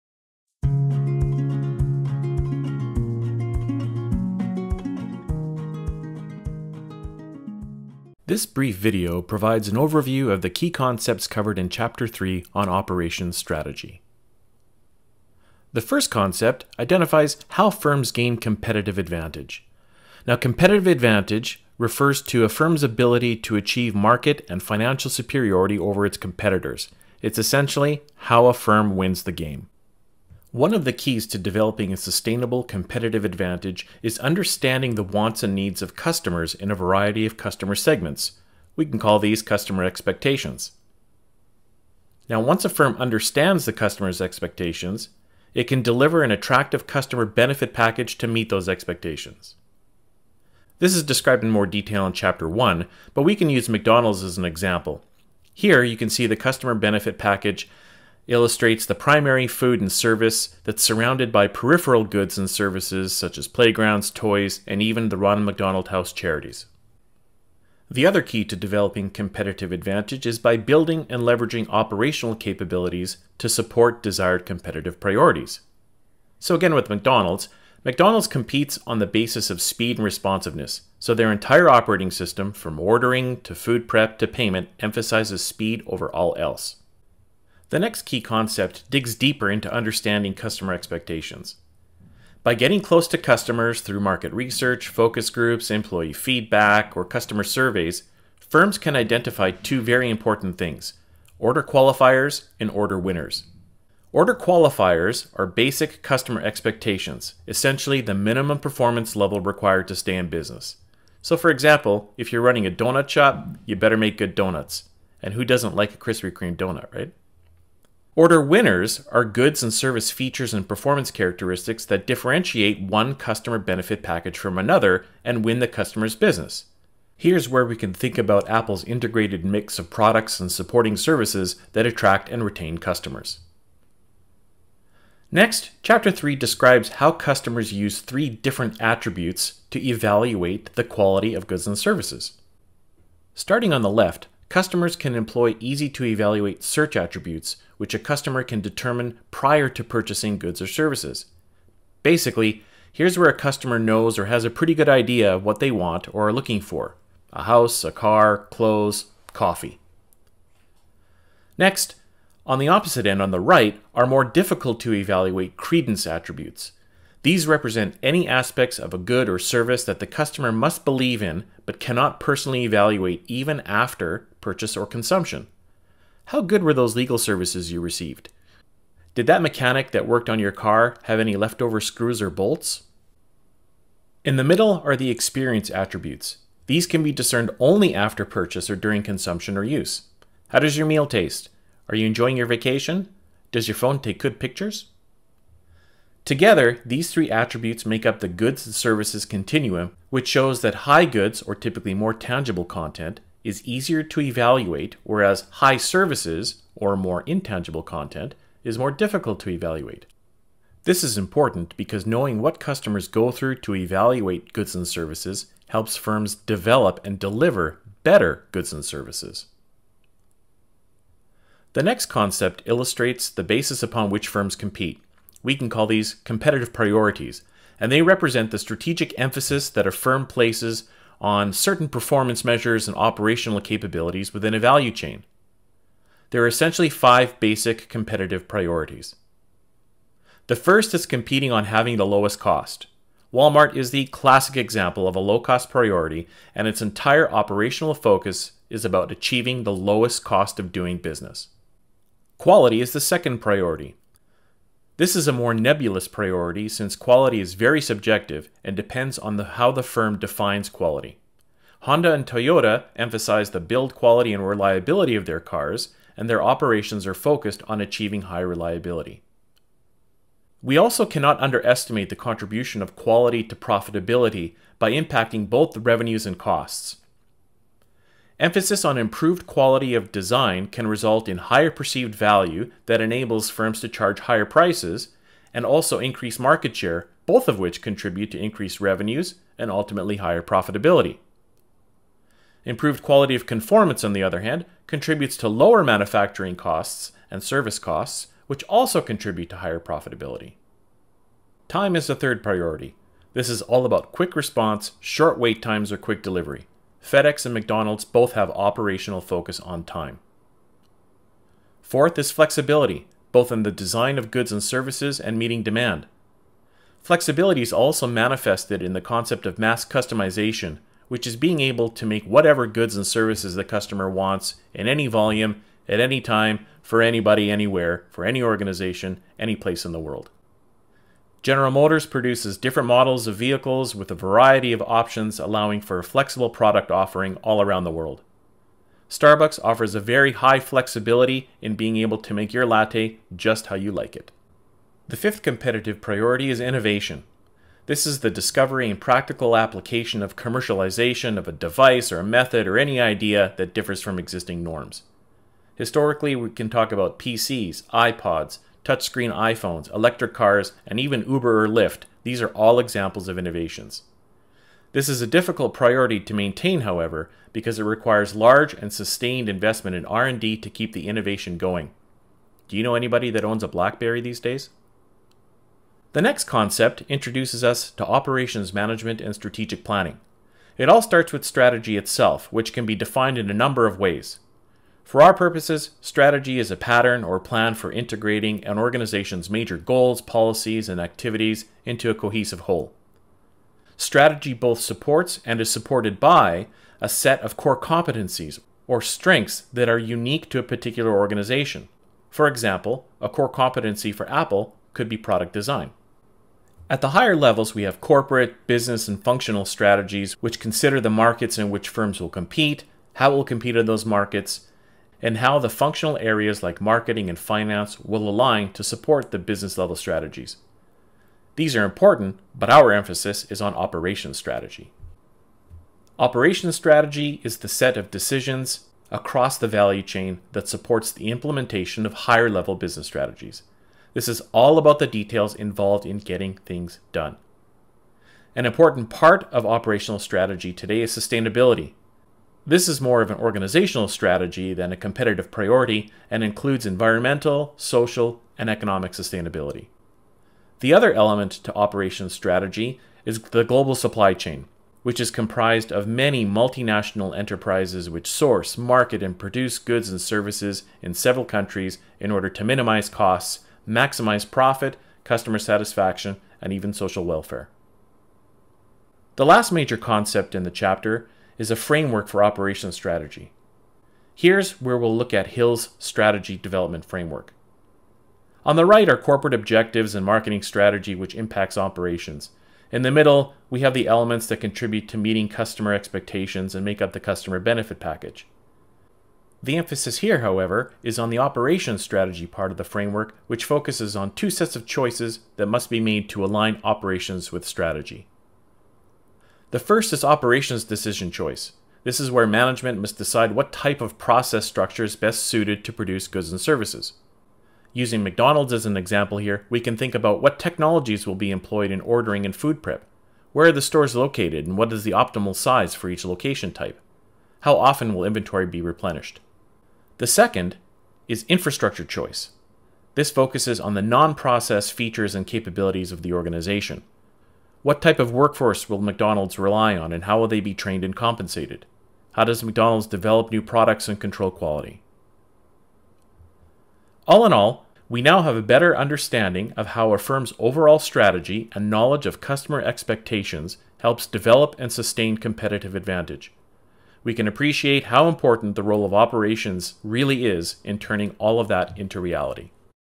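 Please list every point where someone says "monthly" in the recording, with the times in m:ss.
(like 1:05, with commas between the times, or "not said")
not said.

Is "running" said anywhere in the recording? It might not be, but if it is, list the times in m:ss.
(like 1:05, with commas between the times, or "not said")
1:52.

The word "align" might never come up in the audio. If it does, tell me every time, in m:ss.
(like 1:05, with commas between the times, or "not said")
6:58, 8:16.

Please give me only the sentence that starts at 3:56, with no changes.
There are essentially five basic competitive priorities.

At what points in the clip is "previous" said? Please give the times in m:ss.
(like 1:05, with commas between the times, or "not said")
not said.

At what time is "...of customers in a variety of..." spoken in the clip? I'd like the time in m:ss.
0:35.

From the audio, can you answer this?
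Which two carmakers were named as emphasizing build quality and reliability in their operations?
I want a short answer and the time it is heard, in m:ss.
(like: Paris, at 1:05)
Honda and Toyota, at 4:21.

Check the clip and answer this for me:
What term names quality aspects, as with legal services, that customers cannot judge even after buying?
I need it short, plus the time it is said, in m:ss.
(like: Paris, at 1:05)
credence attributes, at 2:45.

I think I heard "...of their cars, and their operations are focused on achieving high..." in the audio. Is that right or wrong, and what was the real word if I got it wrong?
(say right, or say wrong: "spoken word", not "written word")
right.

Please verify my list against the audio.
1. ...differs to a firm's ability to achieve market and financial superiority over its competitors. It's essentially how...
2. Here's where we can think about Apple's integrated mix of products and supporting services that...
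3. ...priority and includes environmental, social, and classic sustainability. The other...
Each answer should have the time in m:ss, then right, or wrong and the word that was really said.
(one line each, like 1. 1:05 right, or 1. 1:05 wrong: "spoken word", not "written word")
1. 0:21 wrong: "refers", not "differs"
2. 2:07 right
3. 7:25 wrong: "economic", not "classic".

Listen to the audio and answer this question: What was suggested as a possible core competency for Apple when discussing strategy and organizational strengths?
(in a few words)
product design.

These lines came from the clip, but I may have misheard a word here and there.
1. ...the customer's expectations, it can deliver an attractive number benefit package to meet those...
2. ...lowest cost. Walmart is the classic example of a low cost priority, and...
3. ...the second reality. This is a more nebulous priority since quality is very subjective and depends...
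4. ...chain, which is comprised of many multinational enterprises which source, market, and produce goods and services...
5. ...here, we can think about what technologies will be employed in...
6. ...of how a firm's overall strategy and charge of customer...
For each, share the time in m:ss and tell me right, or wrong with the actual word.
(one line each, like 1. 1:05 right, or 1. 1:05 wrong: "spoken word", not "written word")
1. 0:43 wrong: "customer", not "number"
2. 4:02 right
3. 4:12 wrong: "priority", not "reality"
4. 7:34 right
5. 8:29 right
6. 8:59 wrong: "knowledge", not "charge".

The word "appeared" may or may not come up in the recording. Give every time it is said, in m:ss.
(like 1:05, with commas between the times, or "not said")
not said.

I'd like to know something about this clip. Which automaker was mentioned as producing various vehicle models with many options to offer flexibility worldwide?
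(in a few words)
General Motors.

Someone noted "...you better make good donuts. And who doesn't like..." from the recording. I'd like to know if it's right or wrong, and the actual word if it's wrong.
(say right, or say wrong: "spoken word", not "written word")
right.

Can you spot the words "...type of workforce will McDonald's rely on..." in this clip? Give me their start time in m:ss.
8:47.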